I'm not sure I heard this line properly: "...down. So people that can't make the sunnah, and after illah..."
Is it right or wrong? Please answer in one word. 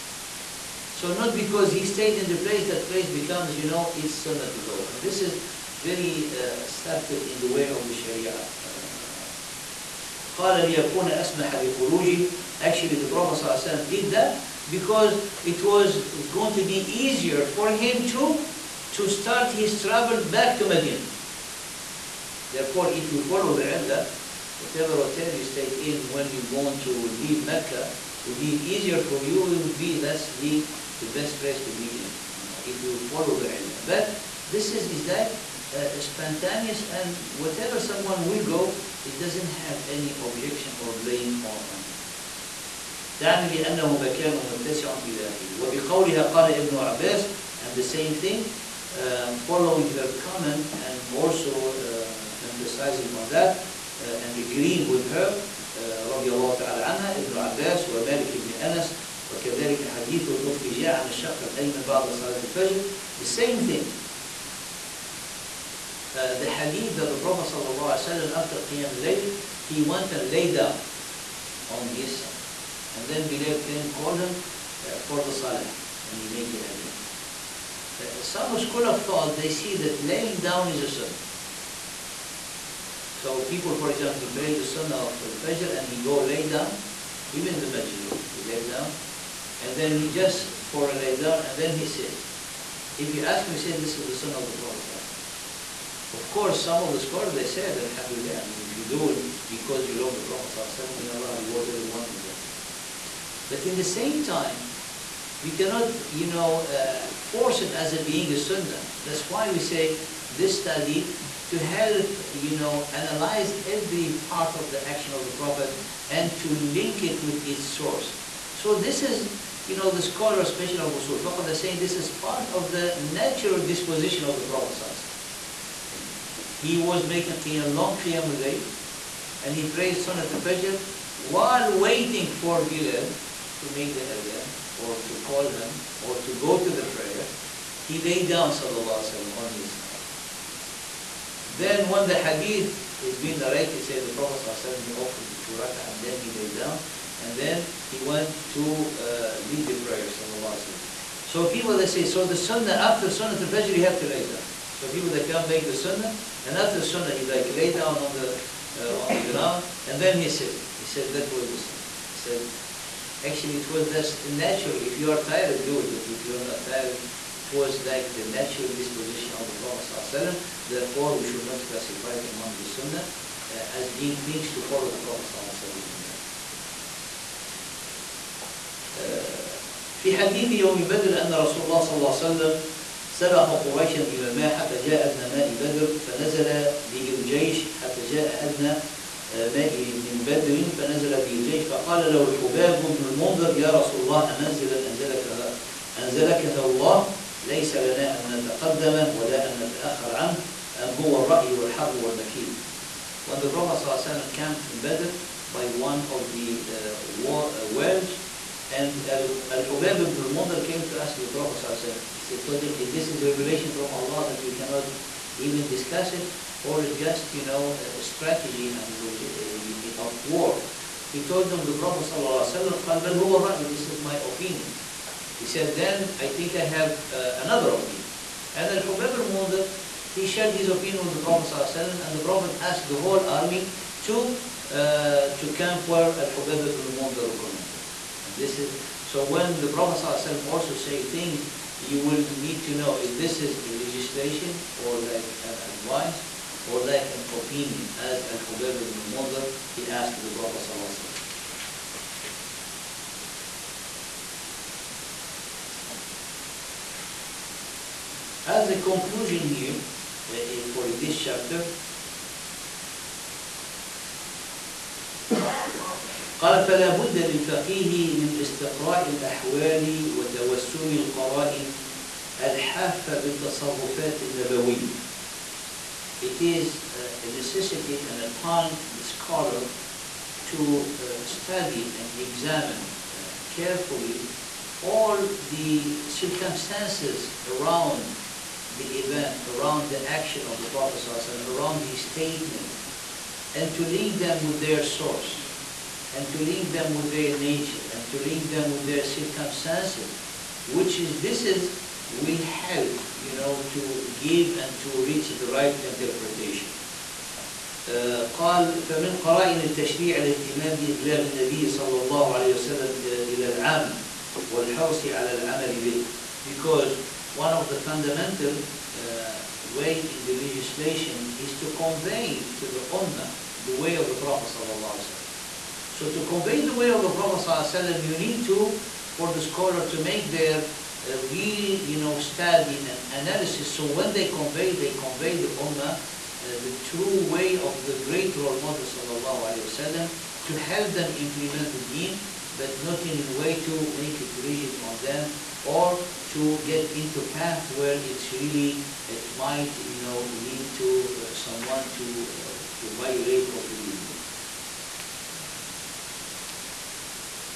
wrong.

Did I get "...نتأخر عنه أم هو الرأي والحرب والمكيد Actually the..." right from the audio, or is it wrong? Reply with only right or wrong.
wrong.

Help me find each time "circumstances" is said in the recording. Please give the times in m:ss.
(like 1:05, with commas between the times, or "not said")
4:46, 4:59.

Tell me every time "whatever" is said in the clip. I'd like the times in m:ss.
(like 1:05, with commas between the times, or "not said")
0:24, 0:37.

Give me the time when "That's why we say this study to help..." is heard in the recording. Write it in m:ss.
1:49.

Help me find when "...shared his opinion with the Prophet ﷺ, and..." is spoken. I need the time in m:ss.
3:50.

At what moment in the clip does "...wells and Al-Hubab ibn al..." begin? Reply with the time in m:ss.
3:27.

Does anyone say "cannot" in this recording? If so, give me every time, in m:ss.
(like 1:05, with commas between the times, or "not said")
1:45, 3:34.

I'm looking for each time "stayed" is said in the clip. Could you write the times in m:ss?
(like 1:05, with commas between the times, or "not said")
0:01, 0:25.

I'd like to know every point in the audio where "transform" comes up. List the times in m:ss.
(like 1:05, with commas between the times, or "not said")
not said.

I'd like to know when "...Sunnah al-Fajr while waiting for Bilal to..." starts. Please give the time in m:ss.
2:09.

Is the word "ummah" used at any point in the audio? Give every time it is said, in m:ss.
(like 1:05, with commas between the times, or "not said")
5:22, 5:35.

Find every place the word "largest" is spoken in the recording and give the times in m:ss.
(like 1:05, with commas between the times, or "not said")
not said.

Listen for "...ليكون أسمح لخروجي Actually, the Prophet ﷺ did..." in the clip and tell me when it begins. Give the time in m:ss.
0:10.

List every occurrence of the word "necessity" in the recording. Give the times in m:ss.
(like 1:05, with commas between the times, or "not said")
4:37.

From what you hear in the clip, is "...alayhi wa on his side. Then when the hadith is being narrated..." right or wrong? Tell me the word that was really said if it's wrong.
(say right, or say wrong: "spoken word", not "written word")
right.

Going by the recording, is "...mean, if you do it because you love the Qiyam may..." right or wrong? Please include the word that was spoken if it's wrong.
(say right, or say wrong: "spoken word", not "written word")
wrong: "Prophet", not "Qiyam".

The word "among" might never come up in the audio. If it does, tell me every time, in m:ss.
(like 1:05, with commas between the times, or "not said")
2:52.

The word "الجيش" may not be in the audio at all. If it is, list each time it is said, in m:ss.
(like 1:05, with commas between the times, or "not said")
3:07, 3:11.